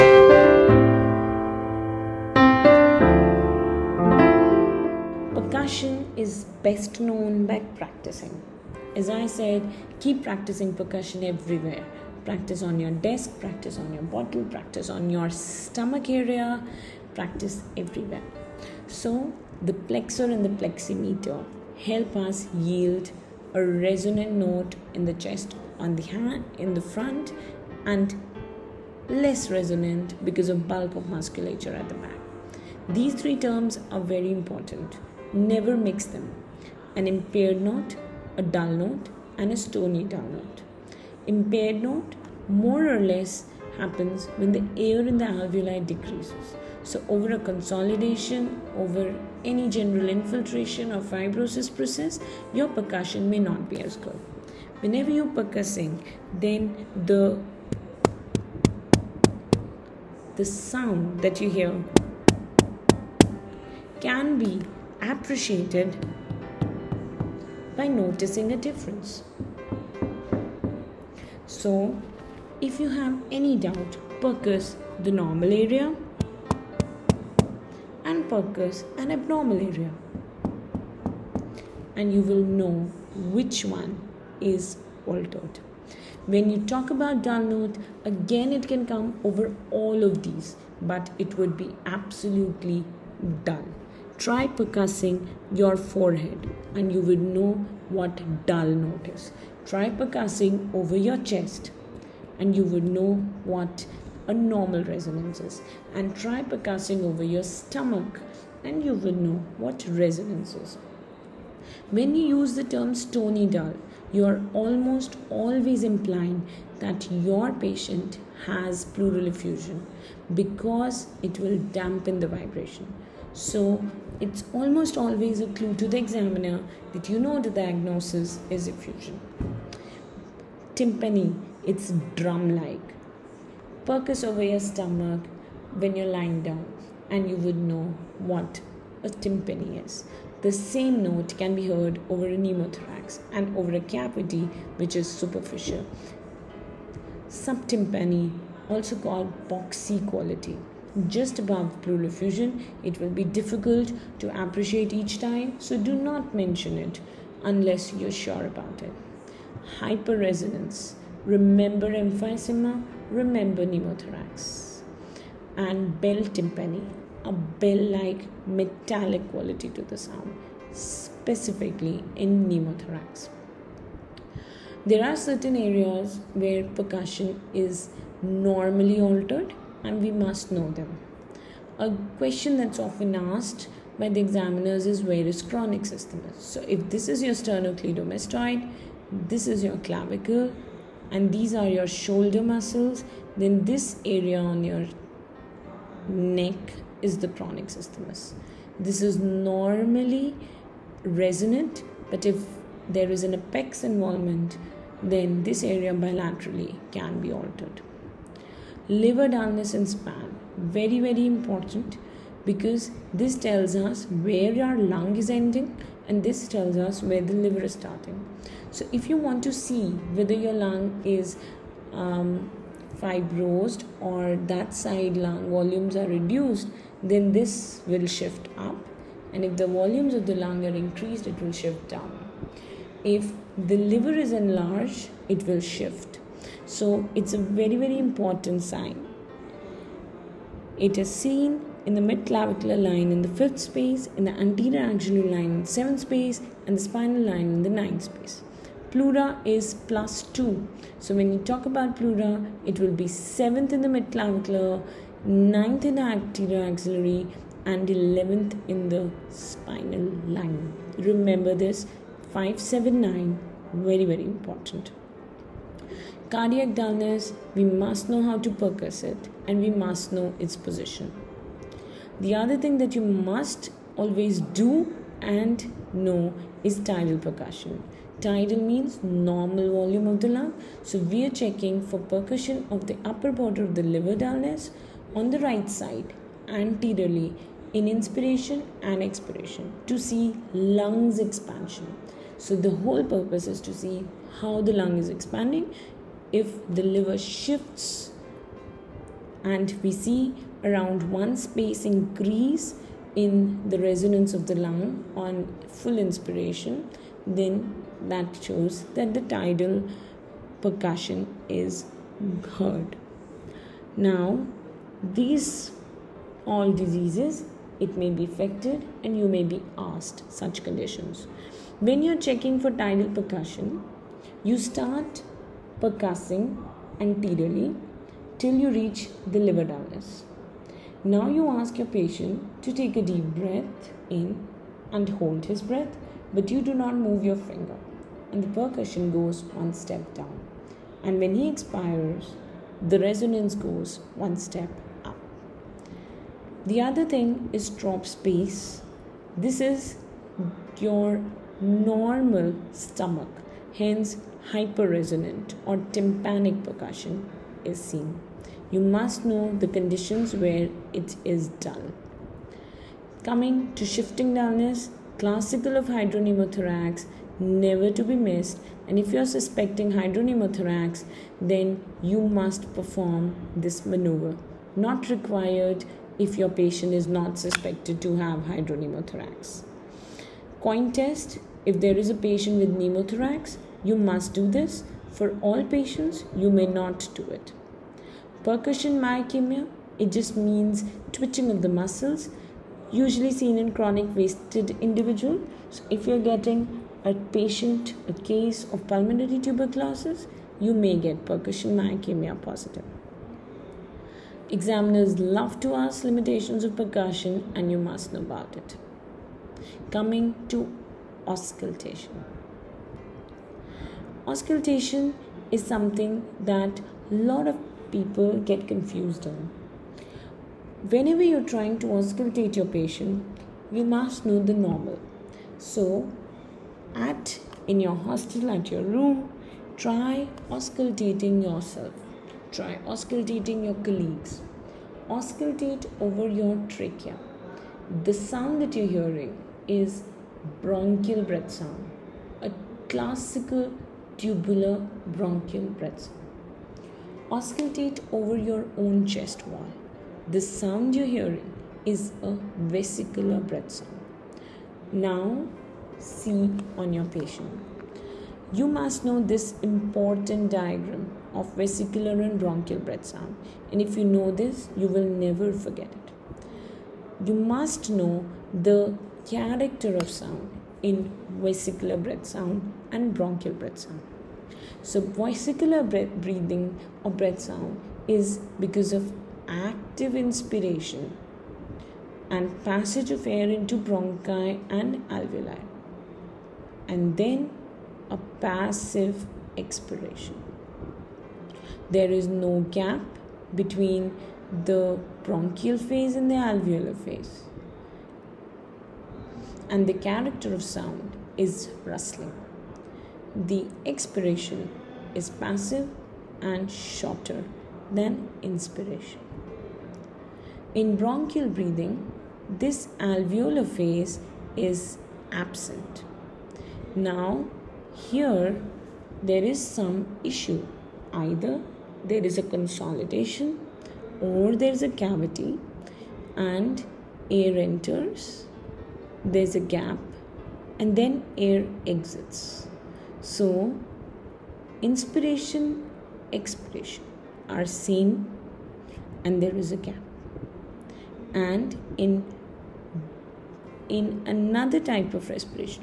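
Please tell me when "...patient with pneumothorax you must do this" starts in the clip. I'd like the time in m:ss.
6:22.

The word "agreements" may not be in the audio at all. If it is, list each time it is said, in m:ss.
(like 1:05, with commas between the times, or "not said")
not said.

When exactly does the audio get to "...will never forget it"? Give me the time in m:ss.
7:44.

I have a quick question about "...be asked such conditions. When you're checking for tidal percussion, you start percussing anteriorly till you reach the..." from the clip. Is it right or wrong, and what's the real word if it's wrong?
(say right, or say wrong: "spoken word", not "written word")
right.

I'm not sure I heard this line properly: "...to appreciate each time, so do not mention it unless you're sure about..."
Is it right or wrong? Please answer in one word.
right.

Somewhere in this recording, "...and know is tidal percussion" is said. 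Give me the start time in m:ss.
4:35.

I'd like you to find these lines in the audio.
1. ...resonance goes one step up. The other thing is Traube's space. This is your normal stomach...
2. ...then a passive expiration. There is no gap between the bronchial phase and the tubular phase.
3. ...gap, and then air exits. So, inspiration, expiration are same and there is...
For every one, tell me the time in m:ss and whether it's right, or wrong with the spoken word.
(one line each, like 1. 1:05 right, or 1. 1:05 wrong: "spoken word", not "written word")
1. 5:42 right
2. 8:07 wrong: "alveolar", not "tubular"
3. 8:49 right.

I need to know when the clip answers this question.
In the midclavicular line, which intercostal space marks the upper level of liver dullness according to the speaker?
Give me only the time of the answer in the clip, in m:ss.
4:03.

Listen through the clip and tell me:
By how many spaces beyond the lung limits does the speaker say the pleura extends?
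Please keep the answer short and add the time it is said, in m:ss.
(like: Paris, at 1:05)
2, at 4:10.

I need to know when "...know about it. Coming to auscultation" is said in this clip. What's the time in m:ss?
6:48.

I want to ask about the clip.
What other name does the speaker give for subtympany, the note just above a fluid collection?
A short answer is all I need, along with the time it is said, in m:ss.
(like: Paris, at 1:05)
boxy quality, at 2:29.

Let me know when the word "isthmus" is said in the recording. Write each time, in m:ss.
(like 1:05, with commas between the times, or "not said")
3:05, 3:17.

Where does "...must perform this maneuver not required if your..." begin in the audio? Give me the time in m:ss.
6:12.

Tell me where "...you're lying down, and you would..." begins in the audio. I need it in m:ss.
2:15.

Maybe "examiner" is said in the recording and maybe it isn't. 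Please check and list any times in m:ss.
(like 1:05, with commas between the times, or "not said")
2:05, 3:04, 6:44.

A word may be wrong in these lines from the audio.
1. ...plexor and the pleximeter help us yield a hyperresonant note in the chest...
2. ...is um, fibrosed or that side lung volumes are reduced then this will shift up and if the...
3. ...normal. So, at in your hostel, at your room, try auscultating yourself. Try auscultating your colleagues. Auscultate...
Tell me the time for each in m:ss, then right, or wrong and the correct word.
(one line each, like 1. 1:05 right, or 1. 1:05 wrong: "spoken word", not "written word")
1. 0:19 wrong: "resonant", not "hyperresonant"
2. 3:41 right
3. 7:04 right.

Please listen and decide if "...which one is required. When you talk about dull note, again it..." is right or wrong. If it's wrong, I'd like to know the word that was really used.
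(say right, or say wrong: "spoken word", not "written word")
wrong: "altered", not "required".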